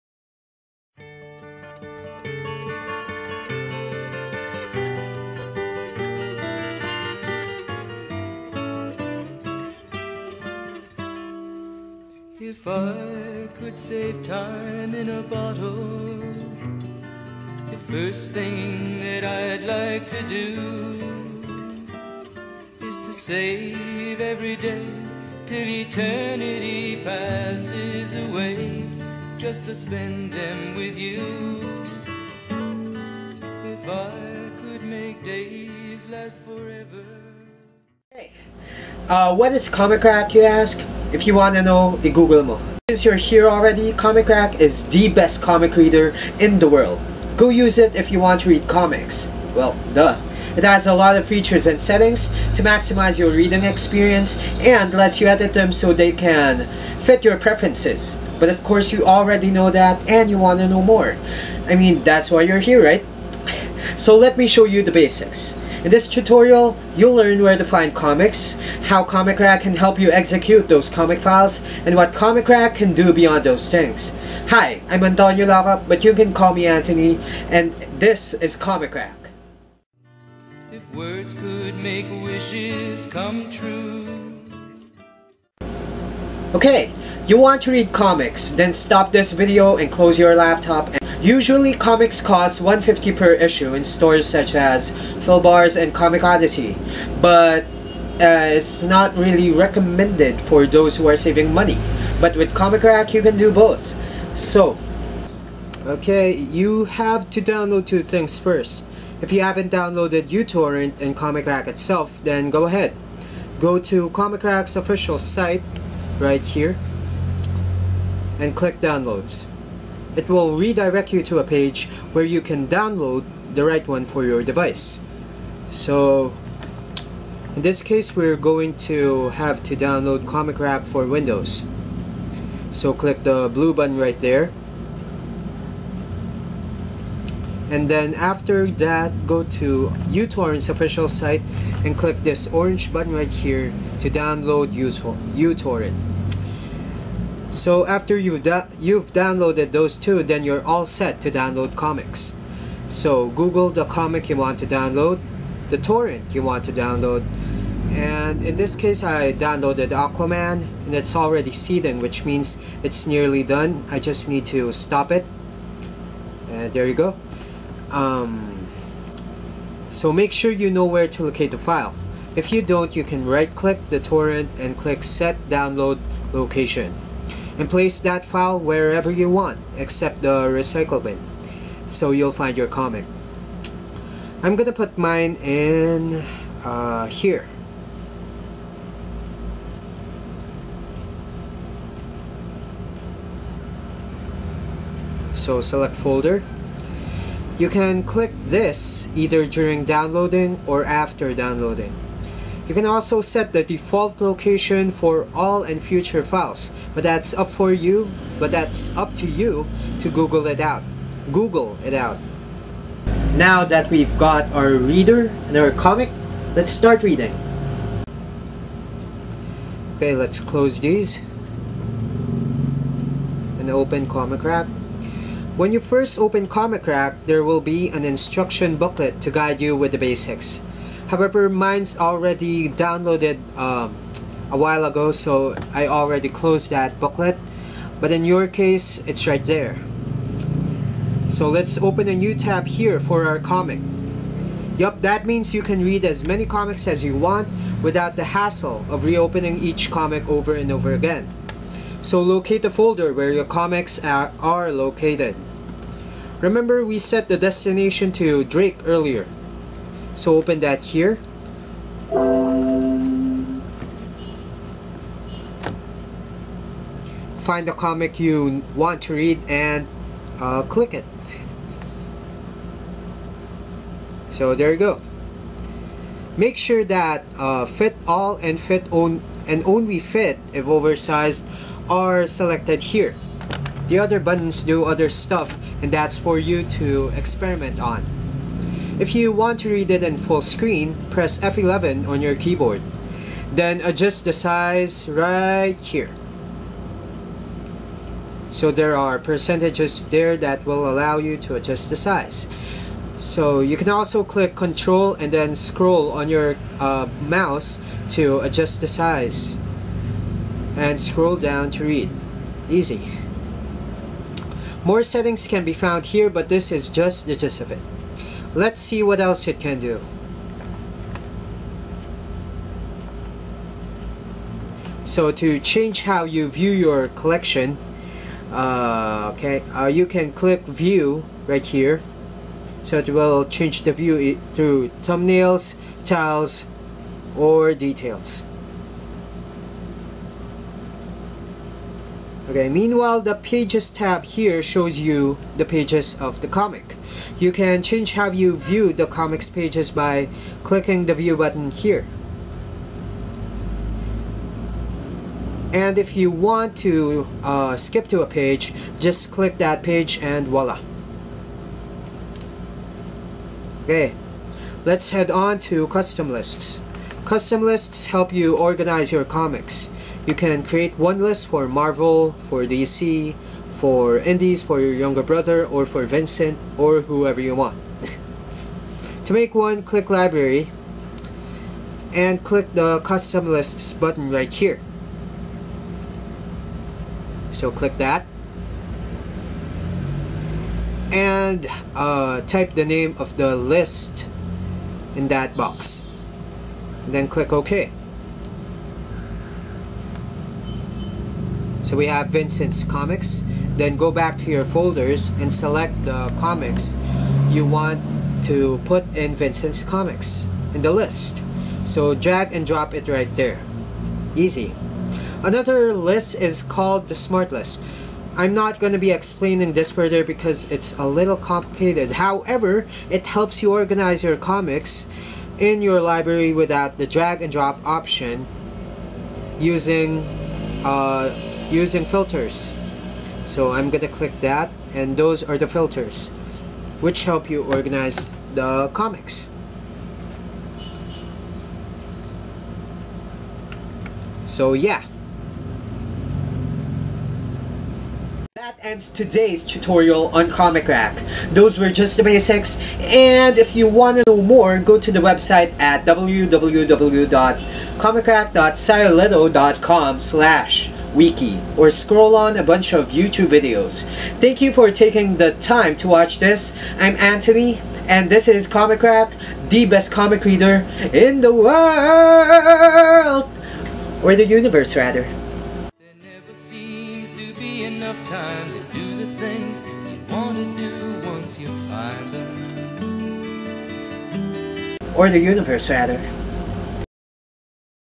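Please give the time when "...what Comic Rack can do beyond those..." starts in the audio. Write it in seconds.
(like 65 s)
71 s.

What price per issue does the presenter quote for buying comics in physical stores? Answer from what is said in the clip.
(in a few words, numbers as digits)
150.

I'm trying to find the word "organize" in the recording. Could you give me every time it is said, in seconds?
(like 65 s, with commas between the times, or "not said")
368 s, 423 s, 437 s.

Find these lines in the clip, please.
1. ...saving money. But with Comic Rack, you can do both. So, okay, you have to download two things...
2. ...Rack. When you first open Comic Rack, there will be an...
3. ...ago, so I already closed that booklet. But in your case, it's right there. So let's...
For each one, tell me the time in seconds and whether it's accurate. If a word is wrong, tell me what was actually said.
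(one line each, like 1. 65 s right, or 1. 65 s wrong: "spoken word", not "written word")
1. 101 s right
2. 224 s right
3. 234 s right.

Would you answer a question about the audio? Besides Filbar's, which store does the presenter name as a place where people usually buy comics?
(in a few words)
Comic Odyssey.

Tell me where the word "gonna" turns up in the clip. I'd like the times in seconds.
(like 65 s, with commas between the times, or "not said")
184 s, 433 s.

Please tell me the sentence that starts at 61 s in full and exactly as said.
I mean, that's why you're here, right?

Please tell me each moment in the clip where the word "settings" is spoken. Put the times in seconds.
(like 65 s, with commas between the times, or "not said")
51 s, 315 s.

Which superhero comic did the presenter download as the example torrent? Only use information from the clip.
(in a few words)
Aquaman.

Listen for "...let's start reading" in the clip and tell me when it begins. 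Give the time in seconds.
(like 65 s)
216 s.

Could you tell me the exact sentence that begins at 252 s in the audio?
So locate the folder where your comics are, are located.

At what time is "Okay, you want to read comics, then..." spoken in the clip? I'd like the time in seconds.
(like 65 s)
86 s.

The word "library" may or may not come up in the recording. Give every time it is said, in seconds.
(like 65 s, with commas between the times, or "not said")
380 s, 425 s.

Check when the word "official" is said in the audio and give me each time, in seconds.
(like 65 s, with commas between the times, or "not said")
114 s, 140 s.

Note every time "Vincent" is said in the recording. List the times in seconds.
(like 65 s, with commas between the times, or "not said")
376 s, 402 s, 409 s.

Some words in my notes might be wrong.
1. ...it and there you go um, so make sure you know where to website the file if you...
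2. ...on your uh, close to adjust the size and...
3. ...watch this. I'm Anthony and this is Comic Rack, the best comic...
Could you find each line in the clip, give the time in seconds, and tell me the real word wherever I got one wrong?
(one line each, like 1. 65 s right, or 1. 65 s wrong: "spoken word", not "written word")
1. 165 s wrong: "locate", not "website"
2. 306 s wrong: "mouse", not "close"
3. 466 s right.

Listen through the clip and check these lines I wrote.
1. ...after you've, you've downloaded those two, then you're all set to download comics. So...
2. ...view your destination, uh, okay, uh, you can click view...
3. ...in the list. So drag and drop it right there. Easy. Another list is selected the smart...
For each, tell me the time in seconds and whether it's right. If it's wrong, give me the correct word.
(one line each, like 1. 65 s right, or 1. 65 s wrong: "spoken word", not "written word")
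1. 147 s right
2. 326 s wrong: "collection", not "destination"
3. 410 s wrong: "called", not "selected".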